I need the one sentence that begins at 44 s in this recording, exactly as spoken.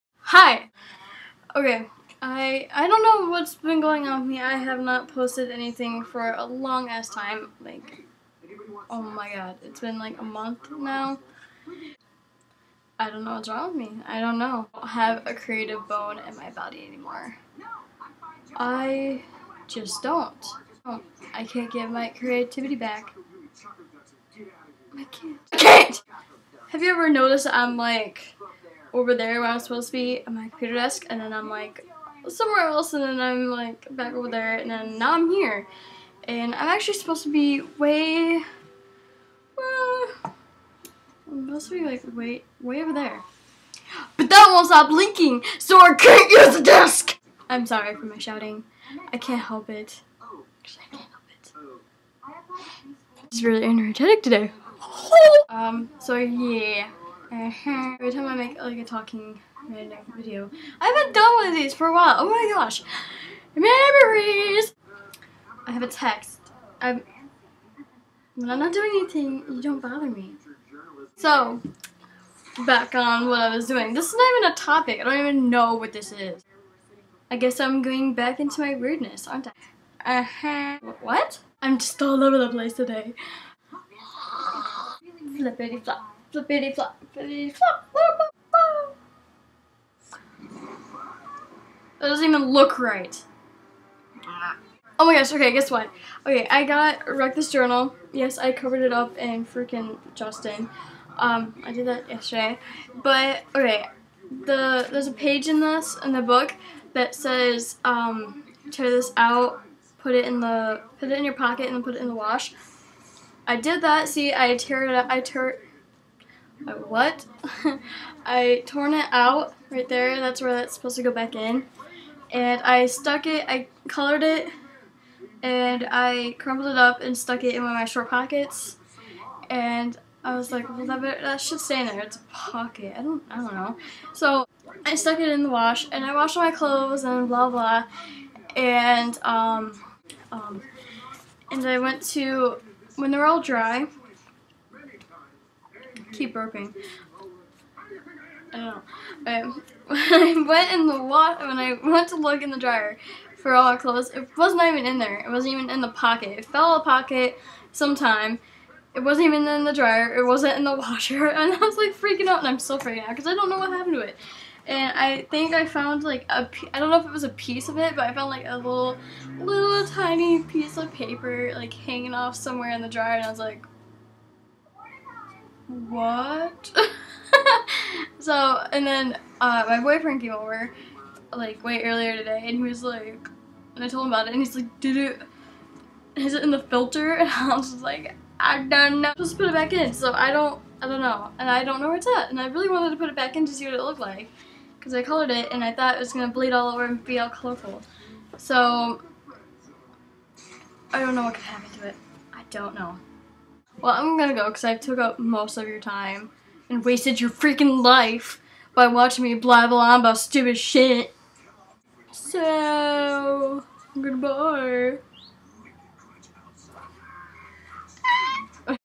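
But that won't stop blinking, so I can't use the desk!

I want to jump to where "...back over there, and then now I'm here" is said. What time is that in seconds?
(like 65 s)
33 s.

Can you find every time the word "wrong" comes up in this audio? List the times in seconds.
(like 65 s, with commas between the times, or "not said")
13 s.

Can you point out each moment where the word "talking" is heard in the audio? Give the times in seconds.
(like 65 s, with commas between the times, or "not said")
58 s.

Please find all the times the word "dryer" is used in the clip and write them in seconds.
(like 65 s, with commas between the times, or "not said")
152 s, 159 s, 172 s.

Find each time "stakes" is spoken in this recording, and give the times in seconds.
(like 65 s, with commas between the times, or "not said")
not said.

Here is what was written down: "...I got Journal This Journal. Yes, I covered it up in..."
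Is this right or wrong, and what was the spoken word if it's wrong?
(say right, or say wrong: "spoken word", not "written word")
wrong: "Wreck", not "Journal".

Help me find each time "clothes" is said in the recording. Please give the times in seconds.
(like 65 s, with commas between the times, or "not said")
136 s, 153 s.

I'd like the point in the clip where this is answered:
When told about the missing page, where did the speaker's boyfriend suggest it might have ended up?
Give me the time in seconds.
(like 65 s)
186 s.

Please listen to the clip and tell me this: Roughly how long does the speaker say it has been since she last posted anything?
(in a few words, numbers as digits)
a month.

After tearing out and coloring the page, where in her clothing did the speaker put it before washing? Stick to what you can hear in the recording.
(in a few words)
short pockets.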